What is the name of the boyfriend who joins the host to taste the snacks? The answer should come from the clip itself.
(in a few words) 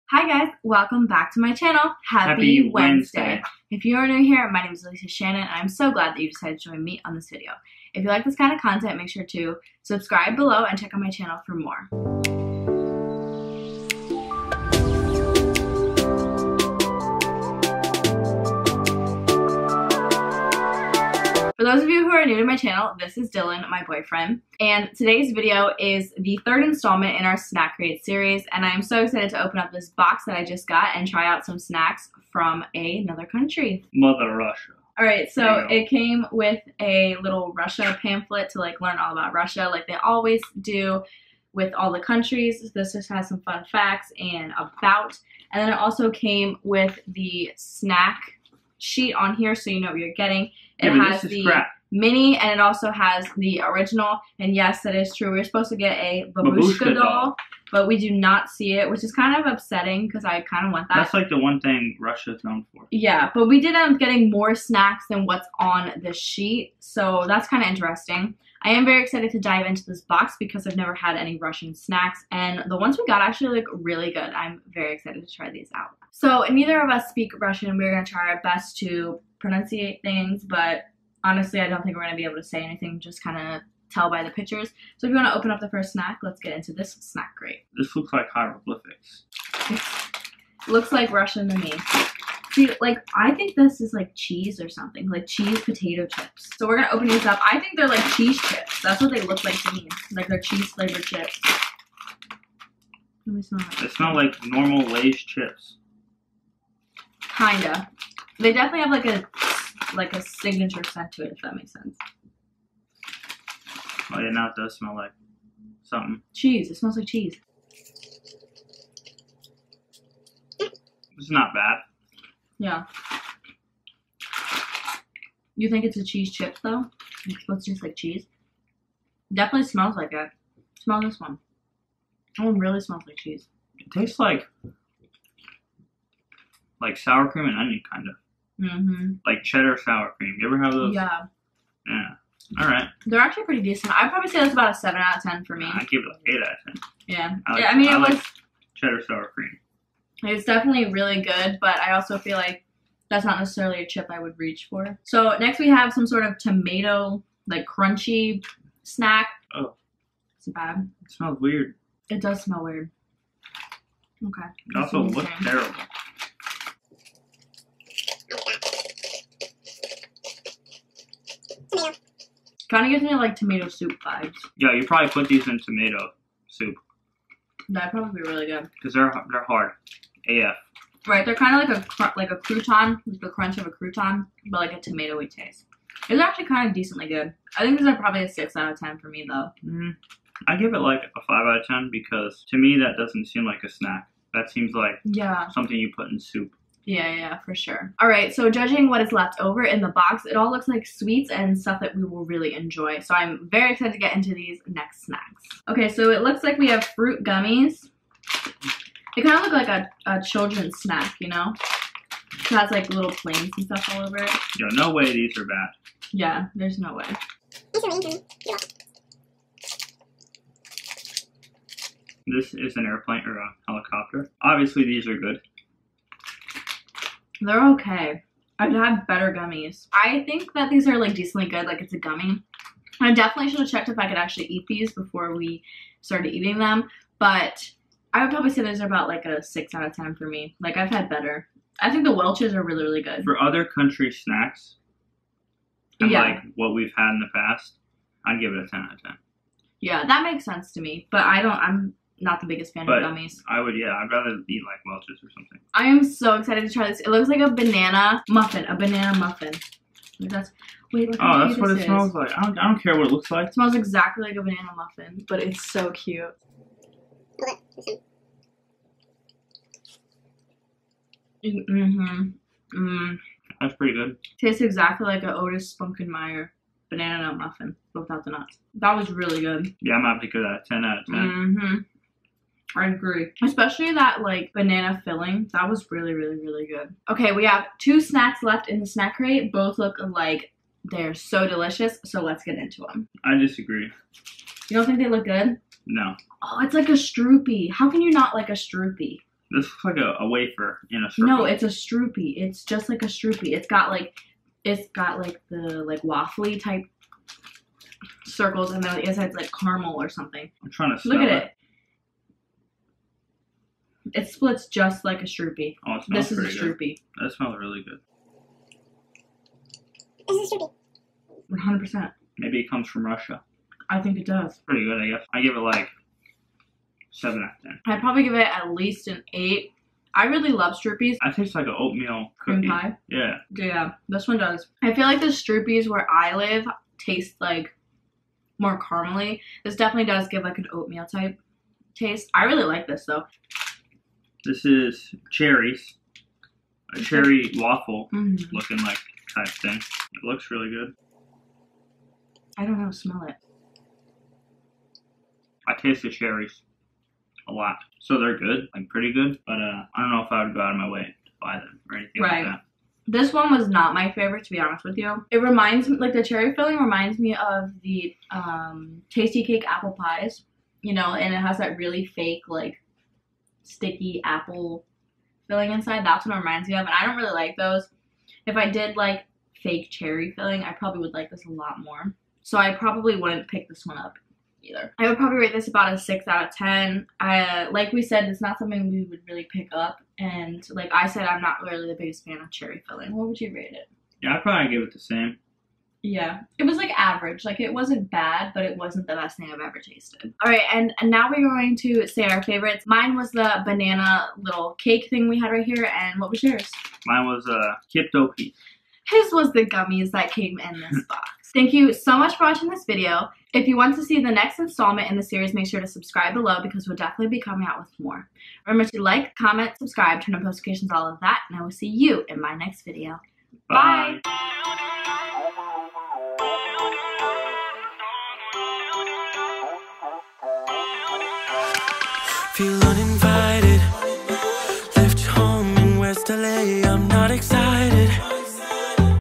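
Dylan.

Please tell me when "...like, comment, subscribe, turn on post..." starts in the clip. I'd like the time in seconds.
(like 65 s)
419 s.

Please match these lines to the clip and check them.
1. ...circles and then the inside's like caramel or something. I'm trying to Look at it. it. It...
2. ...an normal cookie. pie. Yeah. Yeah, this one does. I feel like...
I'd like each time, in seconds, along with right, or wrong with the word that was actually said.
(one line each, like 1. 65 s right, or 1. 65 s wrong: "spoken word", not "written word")
1. 308 s right
2. 331 s wrong: "oatmeal", not "normal".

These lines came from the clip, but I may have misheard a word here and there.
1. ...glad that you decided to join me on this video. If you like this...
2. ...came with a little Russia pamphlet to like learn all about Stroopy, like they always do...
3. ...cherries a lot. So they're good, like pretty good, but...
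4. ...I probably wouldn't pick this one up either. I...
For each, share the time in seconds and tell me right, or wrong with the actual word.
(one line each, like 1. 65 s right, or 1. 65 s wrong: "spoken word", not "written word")
1. 5 s right
2. 35 s wrong: "Russia", not "Stroopy"
3. 356 s right
4. 382 s right.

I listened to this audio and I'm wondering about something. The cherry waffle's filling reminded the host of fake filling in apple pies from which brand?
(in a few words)
Tastykake.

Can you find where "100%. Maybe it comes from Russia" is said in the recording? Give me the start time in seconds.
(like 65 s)
321 s.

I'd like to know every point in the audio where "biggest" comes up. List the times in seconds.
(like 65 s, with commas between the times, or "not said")
252 s, 391 s.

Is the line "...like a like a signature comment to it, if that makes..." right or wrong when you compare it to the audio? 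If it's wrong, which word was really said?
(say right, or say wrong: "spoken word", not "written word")
wrong: "scent", not "comment".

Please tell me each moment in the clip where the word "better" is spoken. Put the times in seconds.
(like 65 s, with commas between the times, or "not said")
229 s, 241 s.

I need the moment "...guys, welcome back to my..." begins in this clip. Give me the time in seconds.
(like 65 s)
0 s.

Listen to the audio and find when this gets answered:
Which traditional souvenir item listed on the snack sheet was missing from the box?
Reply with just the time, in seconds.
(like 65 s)
56 s.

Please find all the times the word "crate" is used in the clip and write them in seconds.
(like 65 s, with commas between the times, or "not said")
27 s, 87 s, 289 s.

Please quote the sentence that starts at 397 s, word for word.
Like it wasn't bad, but it wasn't the best thing I've ever tasted.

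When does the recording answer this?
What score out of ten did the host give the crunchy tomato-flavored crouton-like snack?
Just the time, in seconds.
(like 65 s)
188 s.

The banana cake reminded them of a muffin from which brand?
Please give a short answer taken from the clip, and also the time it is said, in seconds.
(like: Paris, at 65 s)
Otis Spunkmeyer, at 275 s.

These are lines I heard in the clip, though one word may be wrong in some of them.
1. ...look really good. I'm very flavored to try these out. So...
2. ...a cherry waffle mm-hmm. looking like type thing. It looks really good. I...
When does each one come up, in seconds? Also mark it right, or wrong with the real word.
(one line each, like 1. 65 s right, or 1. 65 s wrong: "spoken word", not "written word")
1. 73 s wrong: "excited", not "flavored"
2. 346 s right.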